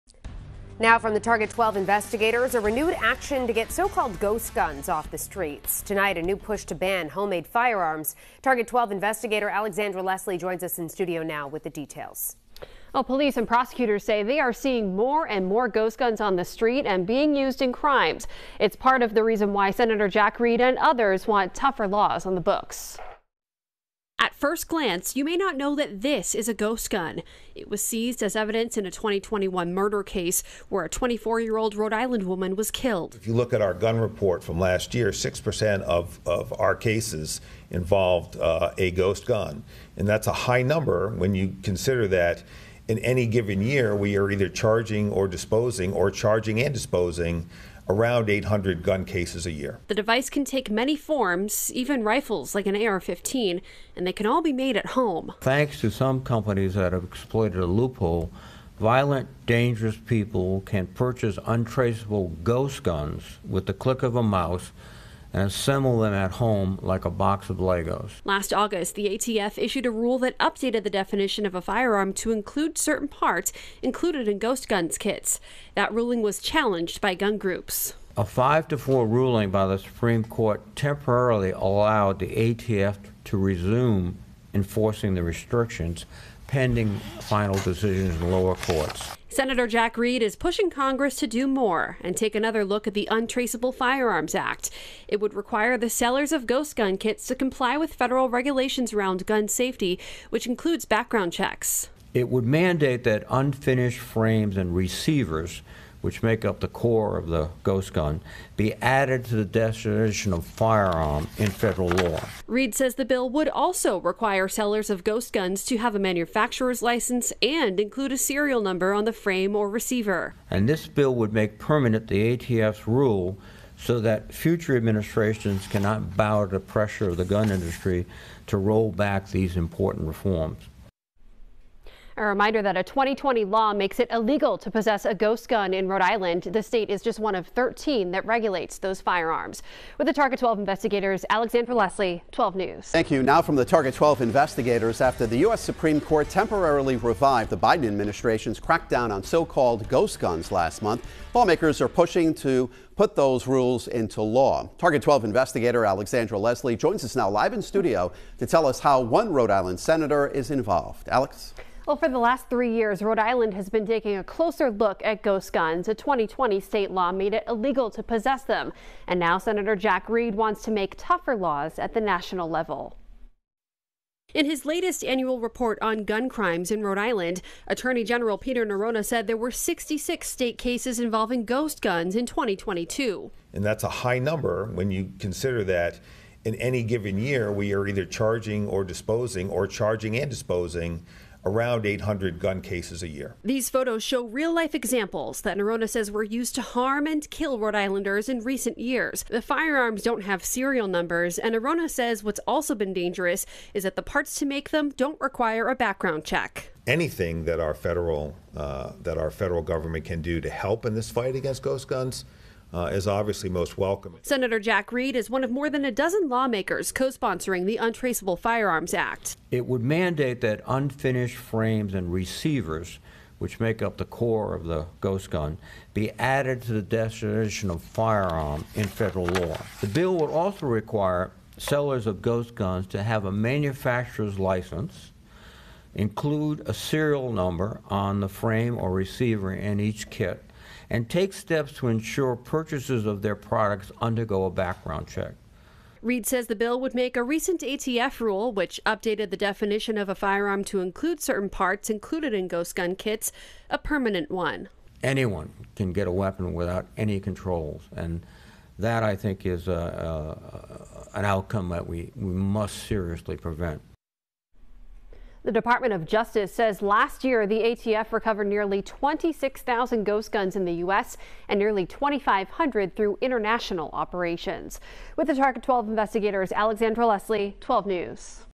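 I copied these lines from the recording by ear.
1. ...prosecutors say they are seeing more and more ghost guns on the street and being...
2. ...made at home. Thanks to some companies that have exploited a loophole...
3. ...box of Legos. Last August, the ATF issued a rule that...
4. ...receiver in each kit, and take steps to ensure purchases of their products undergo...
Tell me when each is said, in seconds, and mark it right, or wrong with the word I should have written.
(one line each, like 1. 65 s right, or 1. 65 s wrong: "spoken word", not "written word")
1. 13 s right
2. 54 s right
3. 67 s right
4. 238 s right.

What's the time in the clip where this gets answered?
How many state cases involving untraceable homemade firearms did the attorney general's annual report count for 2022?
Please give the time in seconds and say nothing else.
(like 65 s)
179 s.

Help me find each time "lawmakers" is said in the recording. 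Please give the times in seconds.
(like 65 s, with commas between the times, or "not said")
151 s, 216 s.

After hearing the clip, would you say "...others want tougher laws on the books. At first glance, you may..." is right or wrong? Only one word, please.
right.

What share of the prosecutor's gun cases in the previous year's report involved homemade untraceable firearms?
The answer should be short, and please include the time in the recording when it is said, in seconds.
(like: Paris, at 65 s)
6%, at 35 s.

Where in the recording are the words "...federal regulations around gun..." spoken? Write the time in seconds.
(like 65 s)
97 s.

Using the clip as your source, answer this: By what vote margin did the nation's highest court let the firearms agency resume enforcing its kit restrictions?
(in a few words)
5 to 4.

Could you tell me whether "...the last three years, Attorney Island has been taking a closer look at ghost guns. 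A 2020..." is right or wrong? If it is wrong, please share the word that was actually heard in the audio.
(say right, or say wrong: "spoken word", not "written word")
wrong: "Rhode", not "Attorney".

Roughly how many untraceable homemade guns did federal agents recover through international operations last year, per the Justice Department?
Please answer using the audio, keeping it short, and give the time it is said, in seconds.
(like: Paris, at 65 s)
2,500, at 271 s.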